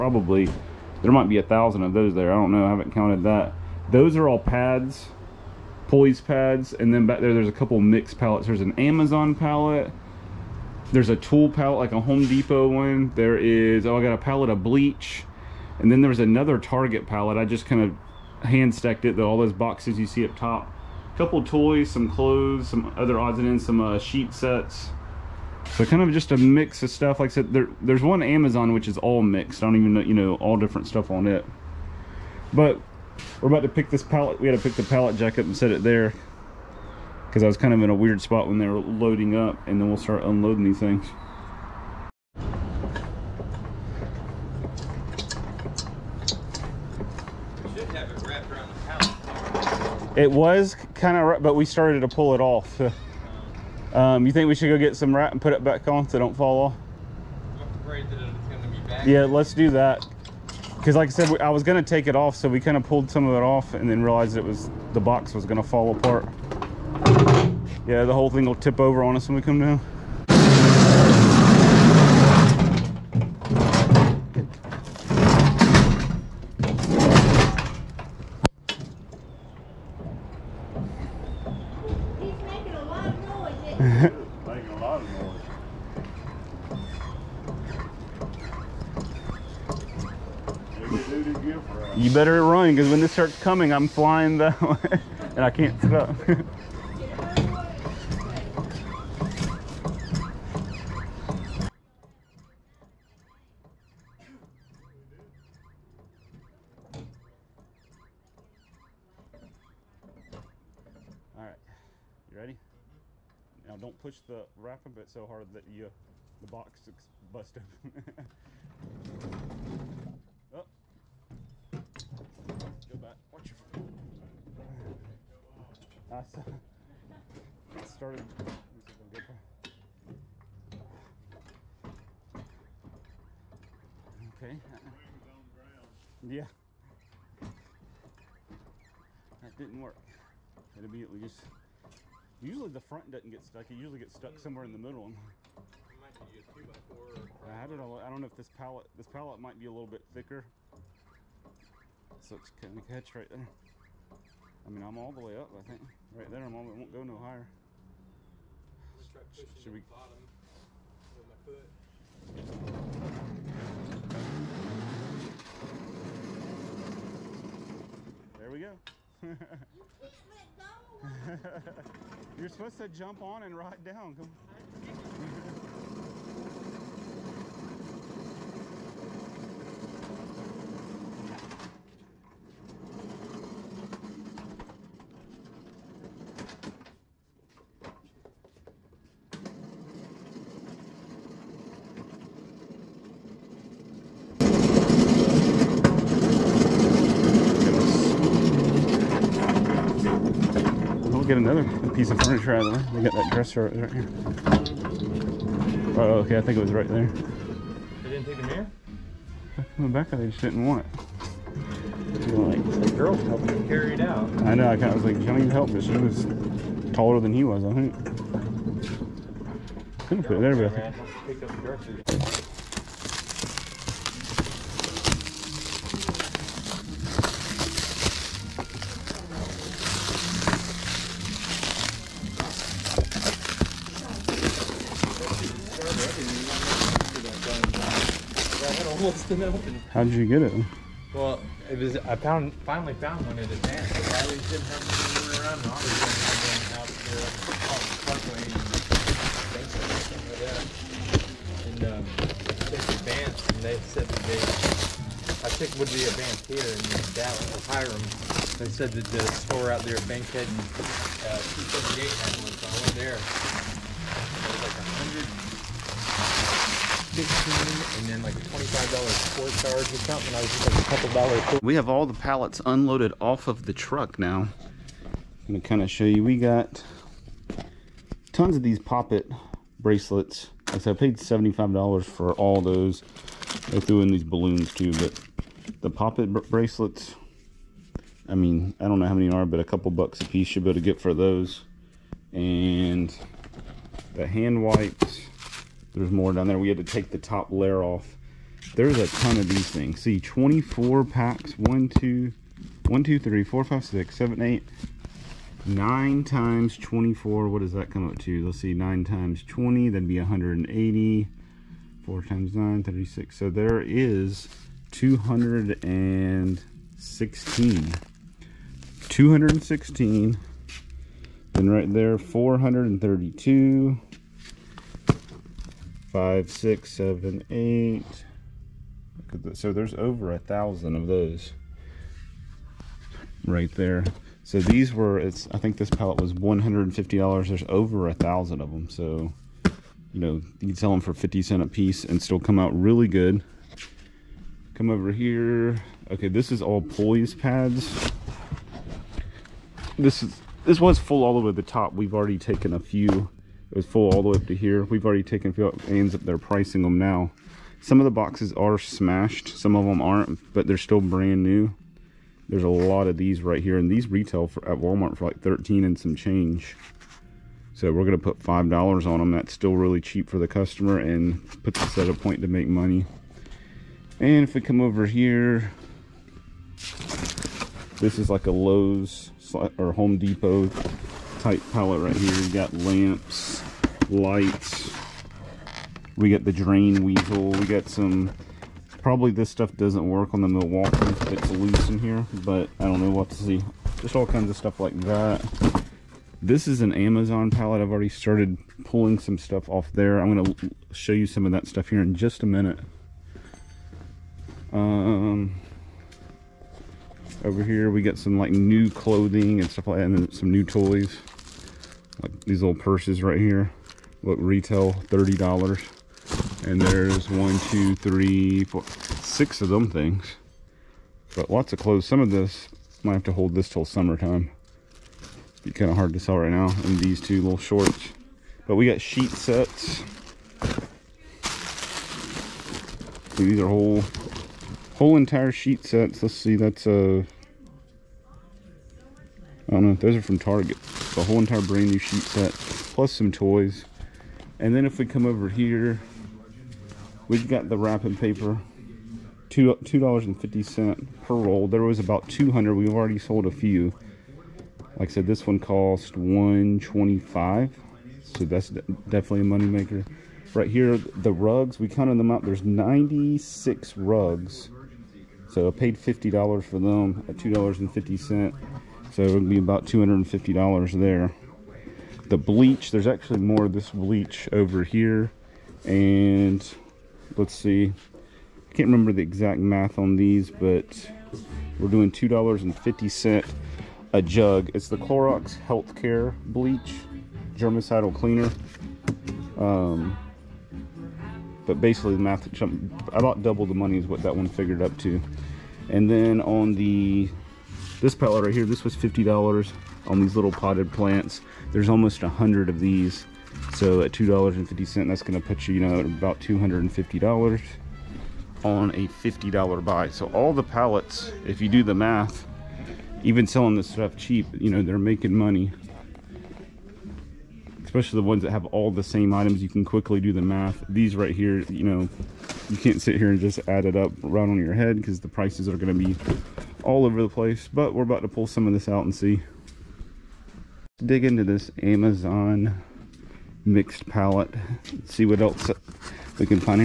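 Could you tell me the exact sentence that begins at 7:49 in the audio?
So it would be about $250 there the bleach.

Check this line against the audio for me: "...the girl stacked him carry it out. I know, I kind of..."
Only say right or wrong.
wrong.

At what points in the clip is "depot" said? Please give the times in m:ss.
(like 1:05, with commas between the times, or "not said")
0:12, 6:20.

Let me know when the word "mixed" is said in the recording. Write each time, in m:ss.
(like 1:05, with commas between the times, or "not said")
0:07, 0:29, 8:53.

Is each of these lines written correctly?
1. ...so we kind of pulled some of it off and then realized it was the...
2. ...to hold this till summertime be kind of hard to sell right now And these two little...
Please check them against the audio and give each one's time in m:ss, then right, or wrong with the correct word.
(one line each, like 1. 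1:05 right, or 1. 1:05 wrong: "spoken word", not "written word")
1. 1:02 right
2. 7:03 right.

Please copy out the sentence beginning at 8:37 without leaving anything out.
Especially the ones that have all the same items, you can quickly do the math.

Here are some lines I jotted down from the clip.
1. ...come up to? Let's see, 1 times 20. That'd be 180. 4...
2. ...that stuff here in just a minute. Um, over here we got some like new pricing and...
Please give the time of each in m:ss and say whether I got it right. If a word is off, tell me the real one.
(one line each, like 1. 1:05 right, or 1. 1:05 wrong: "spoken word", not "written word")
1. 5:07 wrong: "9", not "1"
2. 6:41 wrong: "clothing", not "pricing".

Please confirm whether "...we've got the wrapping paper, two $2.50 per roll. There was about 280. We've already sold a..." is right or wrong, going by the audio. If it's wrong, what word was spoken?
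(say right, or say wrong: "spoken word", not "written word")
wrong: "200", not "280".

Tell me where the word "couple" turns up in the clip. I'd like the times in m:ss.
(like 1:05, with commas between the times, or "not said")
0:07, 0:21, 4:30, 4:49.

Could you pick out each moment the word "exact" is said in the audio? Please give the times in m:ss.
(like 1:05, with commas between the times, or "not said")
7:59.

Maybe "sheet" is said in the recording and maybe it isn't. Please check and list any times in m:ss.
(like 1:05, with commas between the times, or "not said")
0:23, 7:09, 7:15, 7:21.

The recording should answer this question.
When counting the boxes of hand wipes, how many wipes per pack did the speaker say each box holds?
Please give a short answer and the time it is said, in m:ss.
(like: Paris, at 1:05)
24, at 5:00.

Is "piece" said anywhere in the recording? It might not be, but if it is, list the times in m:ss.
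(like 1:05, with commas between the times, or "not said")
3:21, 4:50, 5:41.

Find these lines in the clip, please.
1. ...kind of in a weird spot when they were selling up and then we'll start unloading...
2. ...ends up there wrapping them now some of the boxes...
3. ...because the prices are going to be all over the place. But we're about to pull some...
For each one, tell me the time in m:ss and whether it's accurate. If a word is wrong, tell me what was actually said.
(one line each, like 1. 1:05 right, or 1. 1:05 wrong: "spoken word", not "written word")
1. 0:37 wrong: "loading", not "selling"
2. 5:55 wrong: "pricing", not "wrapping"
3. 8:44 right.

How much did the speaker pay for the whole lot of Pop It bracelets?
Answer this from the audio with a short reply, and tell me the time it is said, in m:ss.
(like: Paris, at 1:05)
$75, at 4:41.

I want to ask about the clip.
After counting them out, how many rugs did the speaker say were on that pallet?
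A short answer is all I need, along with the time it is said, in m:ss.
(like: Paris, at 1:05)
96, at 7:42.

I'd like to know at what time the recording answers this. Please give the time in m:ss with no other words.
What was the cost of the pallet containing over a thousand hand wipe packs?
5:36.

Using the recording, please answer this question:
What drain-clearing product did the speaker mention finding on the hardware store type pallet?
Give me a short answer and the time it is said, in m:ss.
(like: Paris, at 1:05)
drain weasel, at 6:26.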